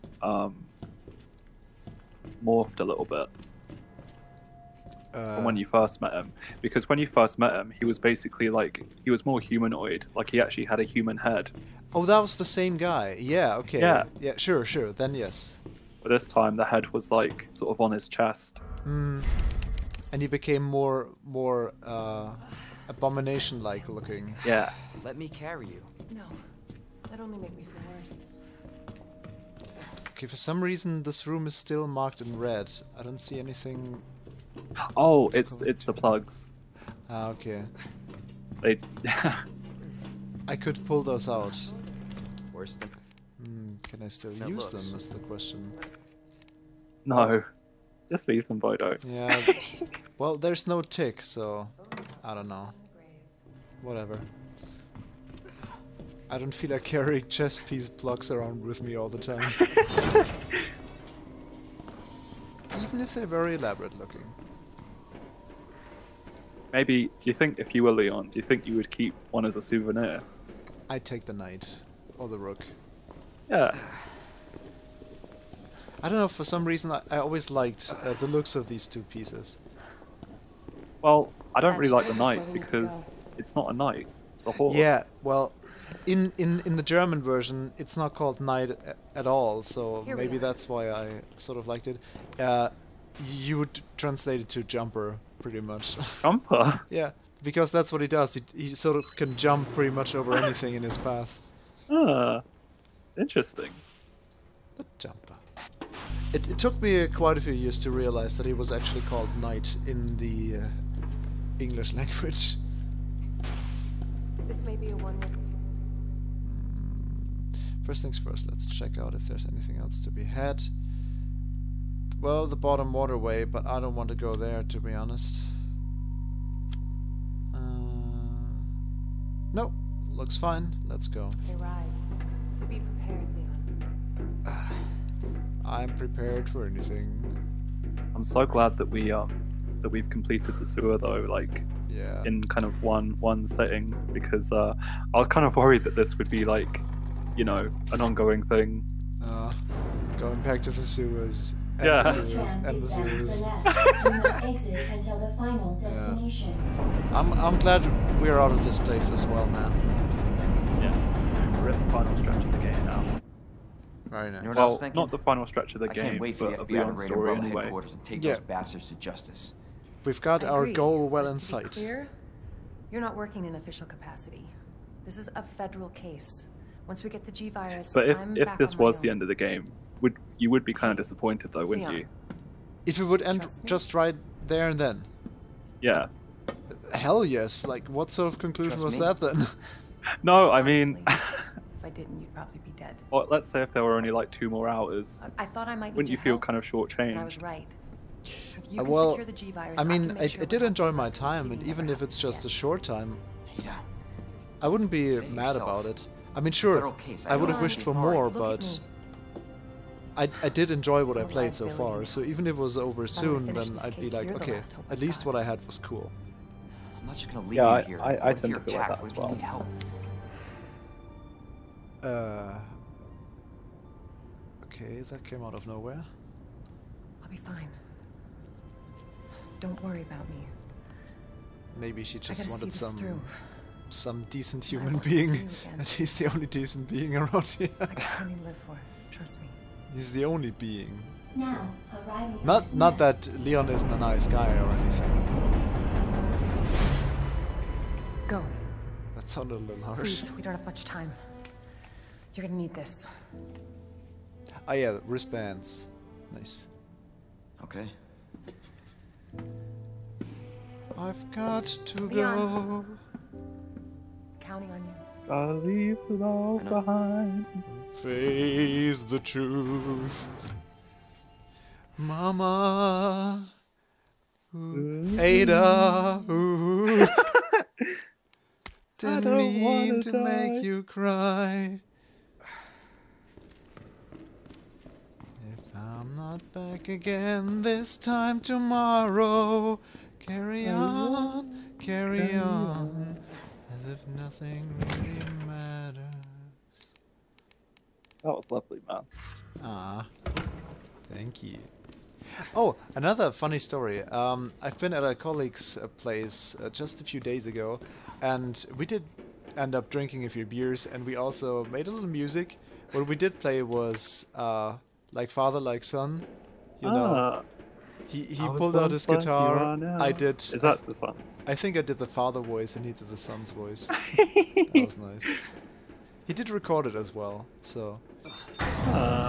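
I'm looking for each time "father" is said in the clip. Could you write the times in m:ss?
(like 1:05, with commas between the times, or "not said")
5:15, 5:22.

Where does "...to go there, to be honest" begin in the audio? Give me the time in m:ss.
2:04.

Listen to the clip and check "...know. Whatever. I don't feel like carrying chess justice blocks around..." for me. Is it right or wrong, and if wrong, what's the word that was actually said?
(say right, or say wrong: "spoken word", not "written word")
wrong: "piece", not "justice".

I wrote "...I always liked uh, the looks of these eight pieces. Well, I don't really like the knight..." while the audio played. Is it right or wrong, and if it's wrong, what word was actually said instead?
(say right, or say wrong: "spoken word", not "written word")
wrong: "two", not "eight".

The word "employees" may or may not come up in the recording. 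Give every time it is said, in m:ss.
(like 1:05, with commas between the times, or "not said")
not said.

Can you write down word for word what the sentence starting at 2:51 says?
Clear, you're not working in official capacity.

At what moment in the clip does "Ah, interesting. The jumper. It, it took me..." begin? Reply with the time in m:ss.
1:41.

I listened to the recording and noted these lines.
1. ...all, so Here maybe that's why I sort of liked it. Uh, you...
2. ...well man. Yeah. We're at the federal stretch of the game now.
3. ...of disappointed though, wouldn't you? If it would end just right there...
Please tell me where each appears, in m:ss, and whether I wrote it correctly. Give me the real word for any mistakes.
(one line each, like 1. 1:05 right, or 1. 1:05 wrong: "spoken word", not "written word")
1. 1:29 right
2. 2:39 wrong: "final", not "federal"
3. 3:00 right.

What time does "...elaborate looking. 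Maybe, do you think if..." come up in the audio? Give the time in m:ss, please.
1:03.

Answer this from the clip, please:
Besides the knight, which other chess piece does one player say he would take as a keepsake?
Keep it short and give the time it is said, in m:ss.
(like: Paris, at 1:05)
rook, at 1:12.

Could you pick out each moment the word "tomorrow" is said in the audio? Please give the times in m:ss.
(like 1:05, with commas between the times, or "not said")
4:48.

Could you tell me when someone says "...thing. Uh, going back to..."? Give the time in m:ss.
2:28.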